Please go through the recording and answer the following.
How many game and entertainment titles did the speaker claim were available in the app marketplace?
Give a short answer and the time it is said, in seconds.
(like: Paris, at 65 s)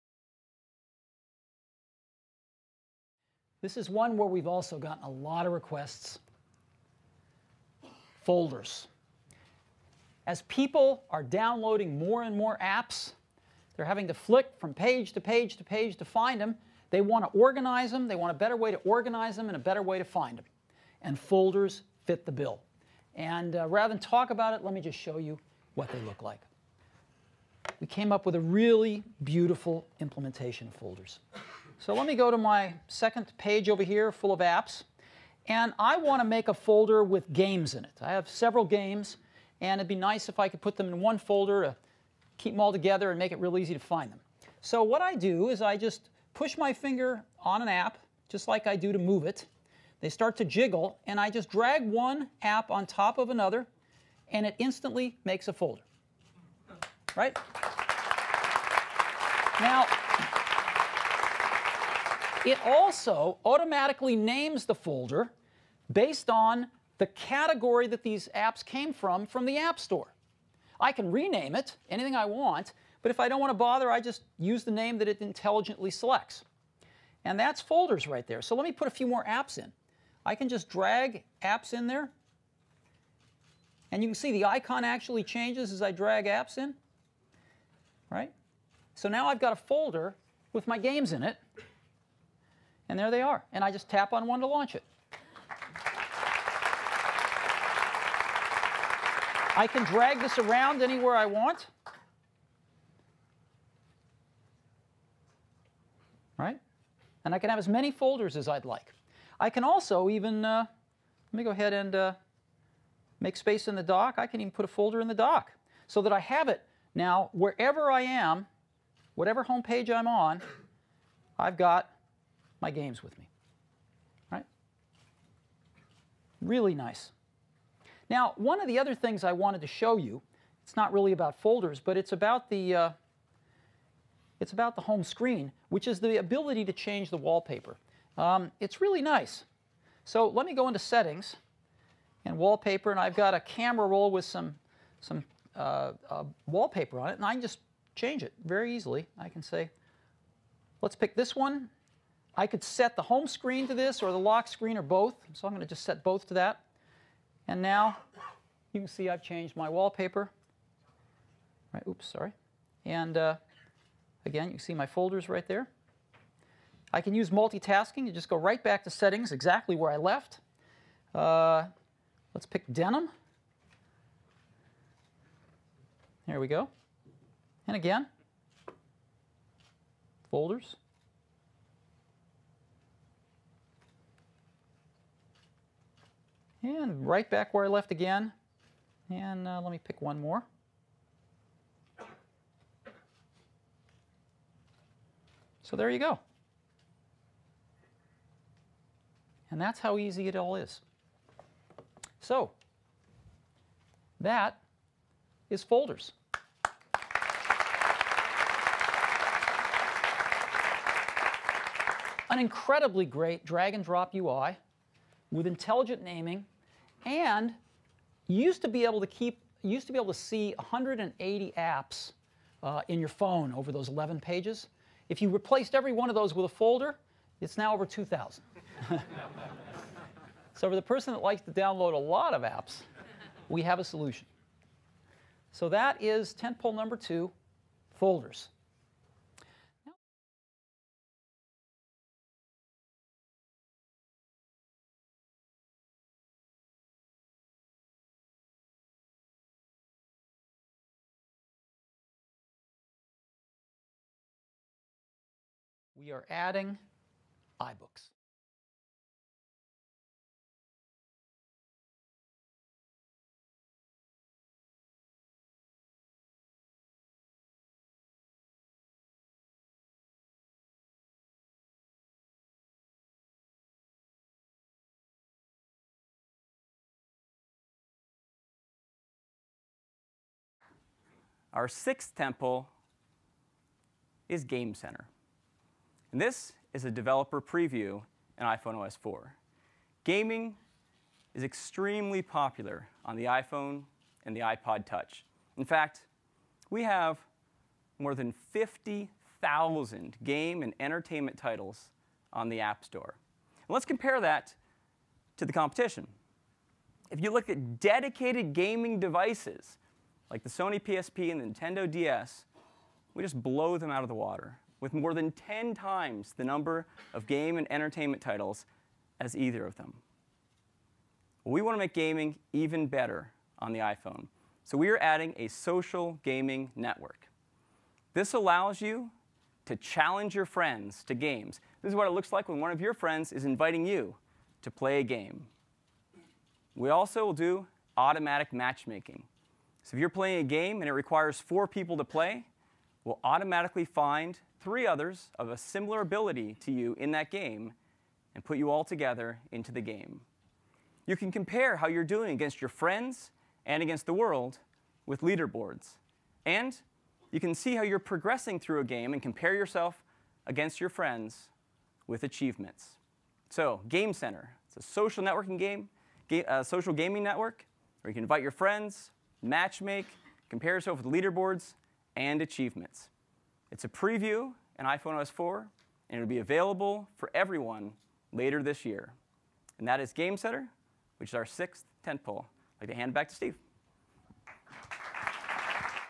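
more than 50,000, at 297 s.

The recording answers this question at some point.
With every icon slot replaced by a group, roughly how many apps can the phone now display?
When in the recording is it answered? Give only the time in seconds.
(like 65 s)
227 s.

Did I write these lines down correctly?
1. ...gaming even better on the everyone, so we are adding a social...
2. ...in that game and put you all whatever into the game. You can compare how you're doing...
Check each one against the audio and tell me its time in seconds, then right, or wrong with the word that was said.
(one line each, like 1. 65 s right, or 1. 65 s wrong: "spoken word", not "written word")
1. 321 s wrong: "iPhone", not "everyone"
2. 346 s wrong: "together", not "whatever".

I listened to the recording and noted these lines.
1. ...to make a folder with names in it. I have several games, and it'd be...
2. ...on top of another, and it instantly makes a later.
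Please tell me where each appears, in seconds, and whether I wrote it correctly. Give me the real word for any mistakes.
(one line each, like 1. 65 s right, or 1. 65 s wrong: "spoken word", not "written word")
1. 36 s wrong: "games", not "names"
2. 52 s wrong: "folder", not "later".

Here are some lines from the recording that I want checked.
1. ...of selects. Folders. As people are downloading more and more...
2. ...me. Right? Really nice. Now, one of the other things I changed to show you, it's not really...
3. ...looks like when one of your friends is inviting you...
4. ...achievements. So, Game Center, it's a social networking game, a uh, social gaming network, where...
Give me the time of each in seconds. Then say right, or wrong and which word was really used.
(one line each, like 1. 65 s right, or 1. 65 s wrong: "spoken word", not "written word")
1. 5 s wrong: "requests", not "selects"
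2. 123 s wrong: "wanted", not "changed"
3. 332 s right
4. 362 s right.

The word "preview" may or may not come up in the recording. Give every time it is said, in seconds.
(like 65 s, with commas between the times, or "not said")
287 s, 373 s.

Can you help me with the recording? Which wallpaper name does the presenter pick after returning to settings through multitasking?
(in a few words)
denim.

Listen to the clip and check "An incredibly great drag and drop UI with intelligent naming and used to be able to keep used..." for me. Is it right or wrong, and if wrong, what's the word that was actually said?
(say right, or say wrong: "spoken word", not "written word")
right.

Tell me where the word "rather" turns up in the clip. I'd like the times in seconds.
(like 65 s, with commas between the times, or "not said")
23 s.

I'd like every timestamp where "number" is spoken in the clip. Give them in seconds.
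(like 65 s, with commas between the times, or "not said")
236 s, 316 s.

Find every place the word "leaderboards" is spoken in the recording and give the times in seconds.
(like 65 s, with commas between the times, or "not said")
355 s, 371 s.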